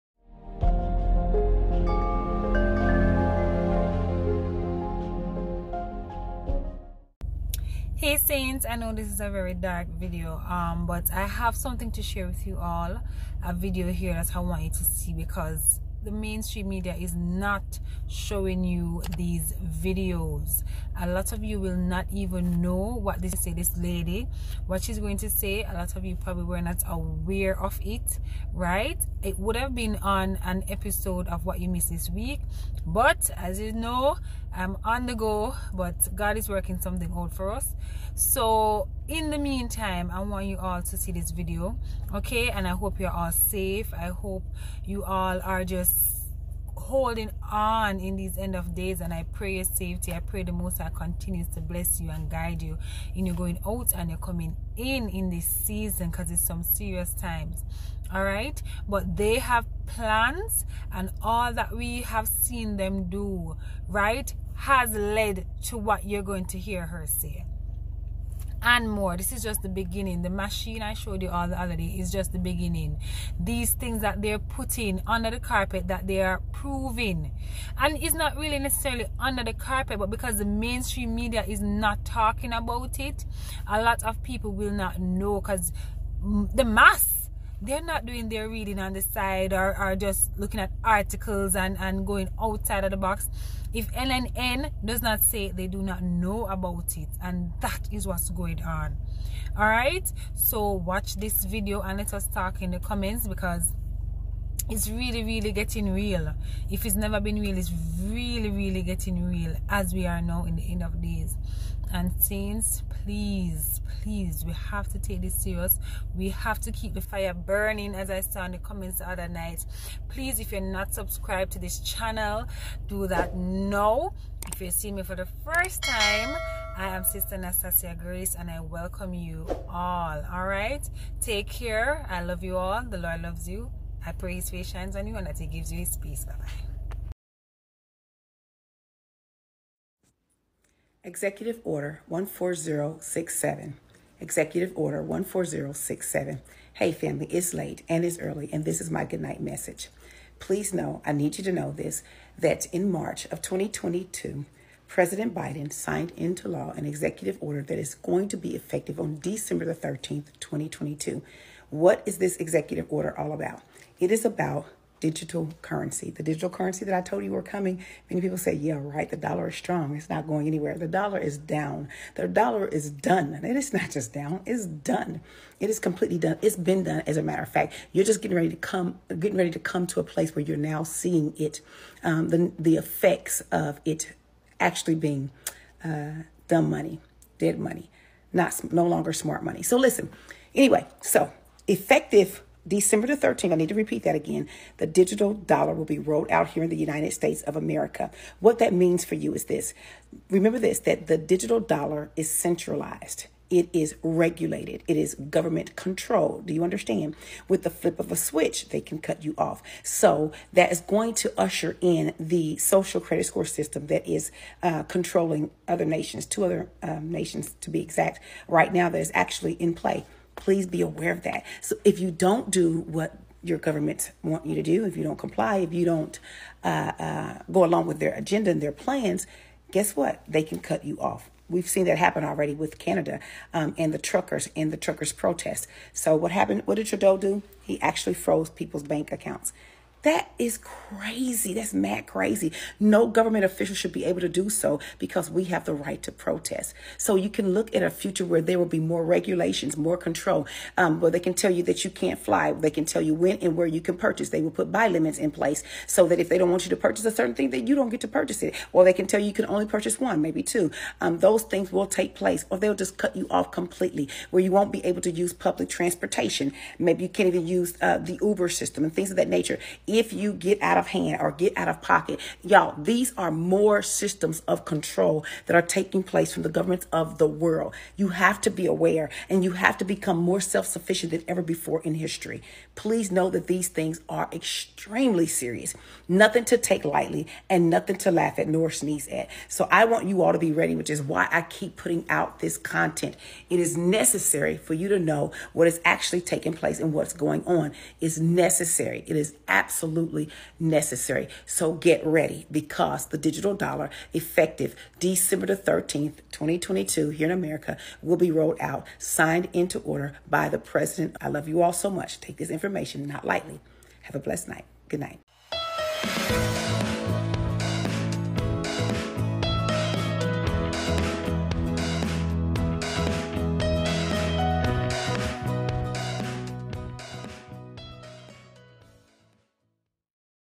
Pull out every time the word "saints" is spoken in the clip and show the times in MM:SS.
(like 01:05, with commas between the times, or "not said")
00:08, 01:52.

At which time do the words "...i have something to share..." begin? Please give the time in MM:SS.
00:11.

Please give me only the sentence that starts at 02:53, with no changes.
And it is not just down, it's done.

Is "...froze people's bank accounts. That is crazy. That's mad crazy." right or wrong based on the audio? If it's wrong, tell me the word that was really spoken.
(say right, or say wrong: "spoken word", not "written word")
right.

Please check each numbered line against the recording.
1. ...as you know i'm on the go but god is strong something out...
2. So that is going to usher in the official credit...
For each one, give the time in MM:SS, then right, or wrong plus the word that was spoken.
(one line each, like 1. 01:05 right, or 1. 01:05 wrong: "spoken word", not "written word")
1. 00:33 wrong: "working", not "strong"
2. 03:29 wrong: "social", not "official".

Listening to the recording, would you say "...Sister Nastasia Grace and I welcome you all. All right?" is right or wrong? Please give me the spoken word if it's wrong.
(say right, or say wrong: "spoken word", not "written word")
right.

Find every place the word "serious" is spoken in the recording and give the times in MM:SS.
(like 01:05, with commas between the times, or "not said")
00:56, 01:55, 04:45.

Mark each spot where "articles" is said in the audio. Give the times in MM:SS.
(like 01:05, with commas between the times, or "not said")
01:30.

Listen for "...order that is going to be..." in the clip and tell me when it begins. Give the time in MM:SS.
02:37.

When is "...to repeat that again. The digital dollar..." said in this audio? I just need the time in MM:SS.
03:13.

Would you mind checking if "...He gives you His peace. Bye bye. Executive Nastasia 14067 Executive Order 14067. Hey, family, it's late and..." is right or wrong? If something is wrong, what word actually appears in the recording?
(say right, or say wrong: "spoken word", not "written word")
wrong: "Order", not "Nastasia".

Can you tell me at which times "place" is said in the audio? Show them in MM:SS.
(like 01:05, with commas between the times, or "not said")
03:00, 04:15, 04:22, 04:36, 04:56.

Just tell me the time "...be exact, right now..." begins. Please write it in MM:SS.
03:37.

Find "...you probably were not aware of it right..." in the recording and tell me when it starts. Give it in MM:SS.
00:26.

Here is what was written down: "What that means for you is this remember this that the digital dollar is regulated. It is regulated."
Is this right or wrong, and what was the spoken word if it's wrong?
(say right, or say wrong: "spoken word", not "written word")
wrong: "centralized", not "regulated".